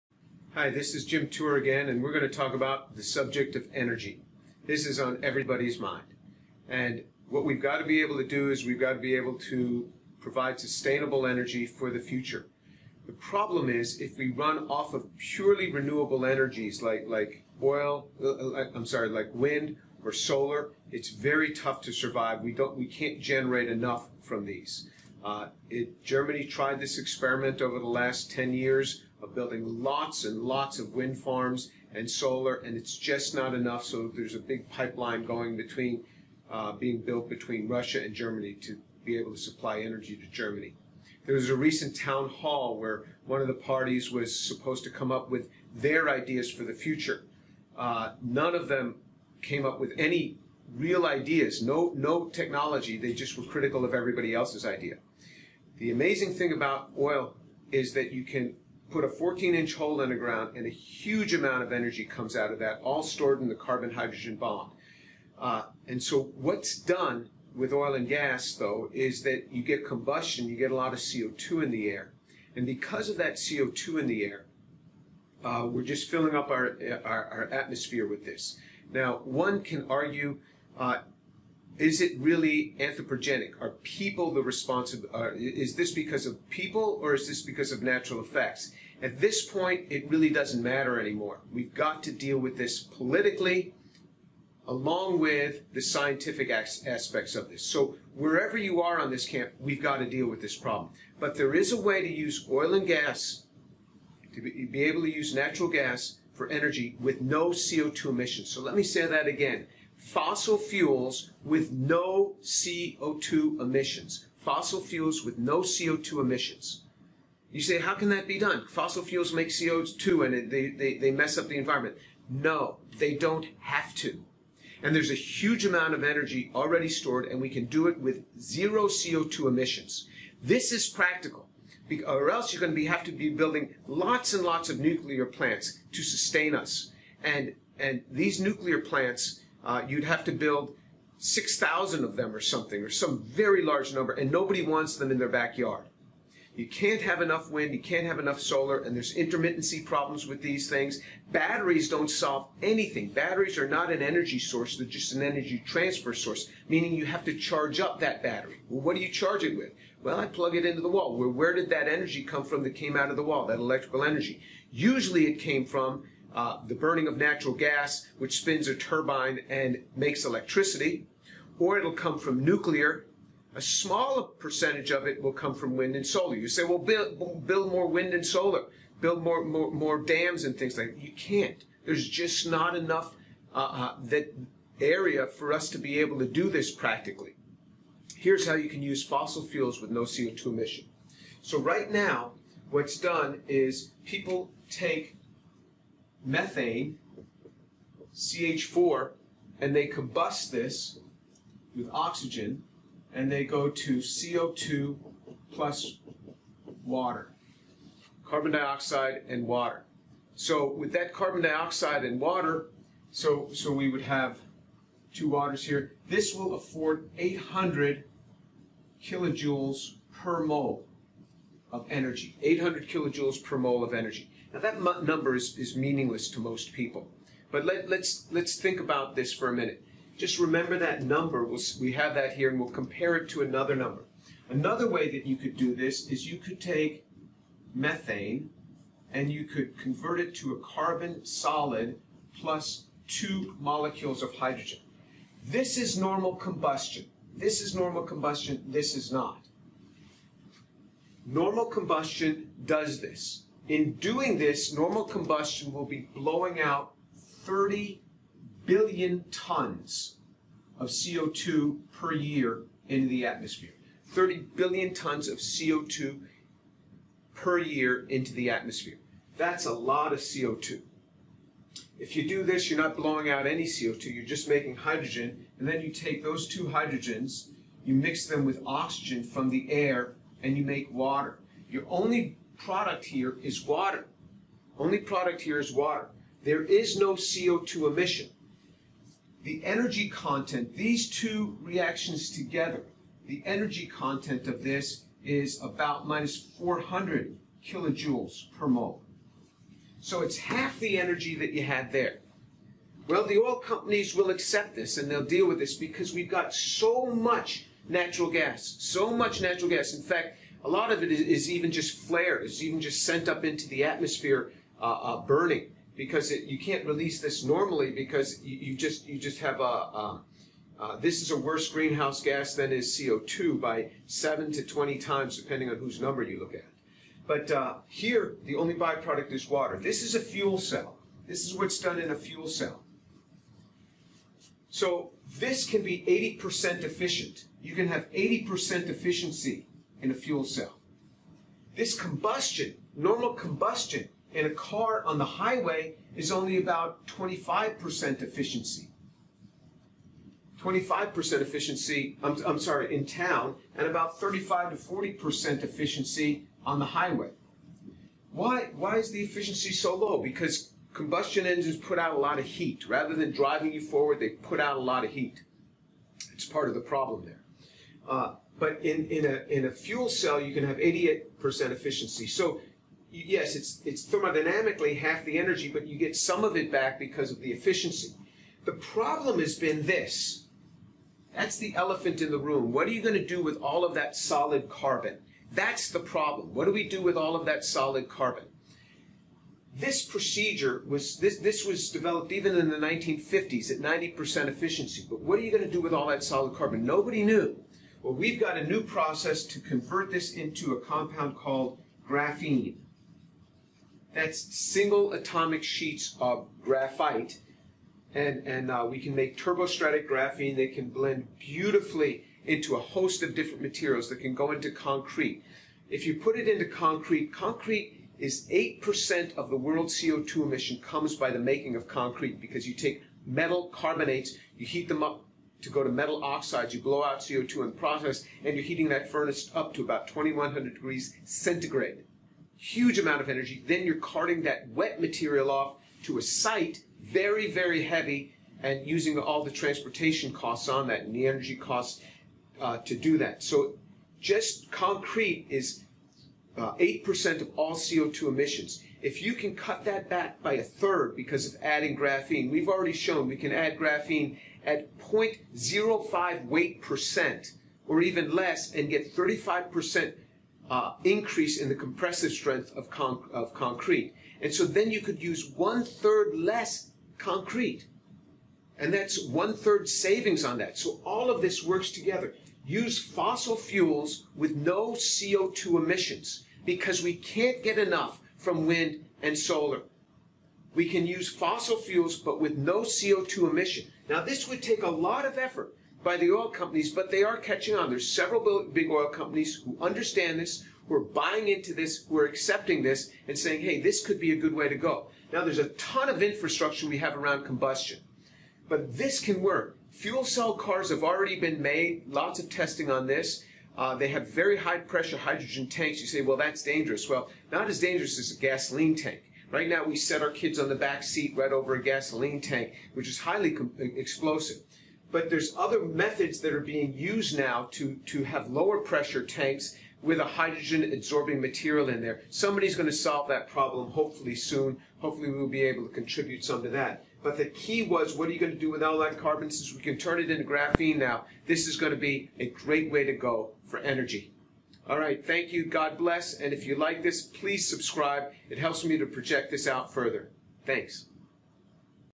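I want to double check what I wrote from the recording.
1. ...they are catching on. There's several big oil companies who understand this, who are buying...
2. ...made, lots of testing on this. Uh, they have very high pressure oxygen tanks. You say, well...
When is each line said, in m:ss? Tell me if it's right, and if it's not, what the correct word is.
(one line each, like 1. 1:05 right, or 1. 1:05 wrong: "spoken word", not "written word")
1. 8:07 right
2. 8:21 wrong: "hydrogen", not "oxygen".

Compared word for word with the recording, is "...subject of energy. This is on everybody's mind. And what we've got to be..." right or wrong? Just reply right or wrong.
right.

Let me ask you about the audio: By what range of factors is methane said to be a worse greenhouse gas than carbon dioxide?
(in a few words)
7 to 20 times.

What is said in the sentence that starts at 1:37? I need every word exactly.
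So wherever you are on this camp, we've got to deal with this problem.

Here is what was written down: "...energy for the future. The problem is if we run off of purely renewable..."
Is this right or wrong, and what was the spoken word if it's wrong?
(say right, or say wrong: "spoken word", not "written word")
right.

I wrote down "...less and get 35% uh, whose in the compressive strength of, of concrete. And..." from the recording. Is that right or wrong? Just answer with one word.
wrong.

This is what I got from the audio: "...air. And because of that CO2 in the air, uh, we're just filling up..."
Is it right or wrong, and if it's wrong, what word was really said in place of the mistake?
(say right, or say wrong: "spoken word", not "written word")
right.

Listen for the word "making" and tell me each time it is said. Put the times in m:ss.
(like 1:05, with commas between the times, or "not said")
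4:34, 7:01.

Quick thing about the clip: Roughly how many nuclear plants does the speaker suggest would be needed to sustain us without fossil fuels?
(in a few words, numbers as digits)
6,000.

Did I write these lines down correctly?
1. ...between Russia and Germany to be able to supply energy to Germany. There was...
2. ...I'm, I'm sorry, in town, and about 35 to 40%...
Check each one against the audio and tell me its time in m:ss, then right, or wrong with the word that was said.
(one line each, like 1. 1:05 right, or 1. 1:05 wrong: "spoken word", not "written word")
1. 0:37 right
2. 5:52 right.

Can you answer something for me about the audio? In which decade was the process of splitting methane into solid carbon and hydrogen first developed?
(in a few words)
1950s.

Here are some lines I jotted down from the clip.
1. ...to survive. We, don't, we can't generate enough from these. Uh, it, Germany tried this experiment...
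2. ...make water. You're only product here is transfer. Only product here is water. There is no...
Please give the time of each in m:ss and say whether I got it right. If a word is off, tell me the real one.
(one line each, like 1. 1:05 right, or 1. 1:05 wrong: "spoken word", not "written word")
1. 0:21 right
2. 4:40 wrong: "water", not "transfer".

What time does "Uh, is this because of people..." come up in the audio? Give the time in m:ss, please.
1:25.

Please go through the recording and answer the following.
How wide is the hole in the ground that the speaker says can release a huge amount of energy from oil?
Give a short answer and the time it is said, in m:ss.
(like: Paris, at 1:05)
14 inch, at 0:59.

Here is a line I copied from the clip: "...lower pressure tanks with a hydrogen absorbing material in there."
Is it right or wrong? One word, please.
right.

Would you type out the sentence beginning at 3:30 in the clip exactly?
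So with that carbon dioxide and water, so, so we would have two waters here.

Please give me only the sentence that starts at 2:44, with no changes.
Usually it came from uh, the burning of natural gas, which spins a turbine and makes electricity, or it'll come from nuclear.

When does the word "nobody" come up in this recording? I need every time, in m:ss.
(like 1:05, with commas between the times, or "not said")
2:24, 6:36.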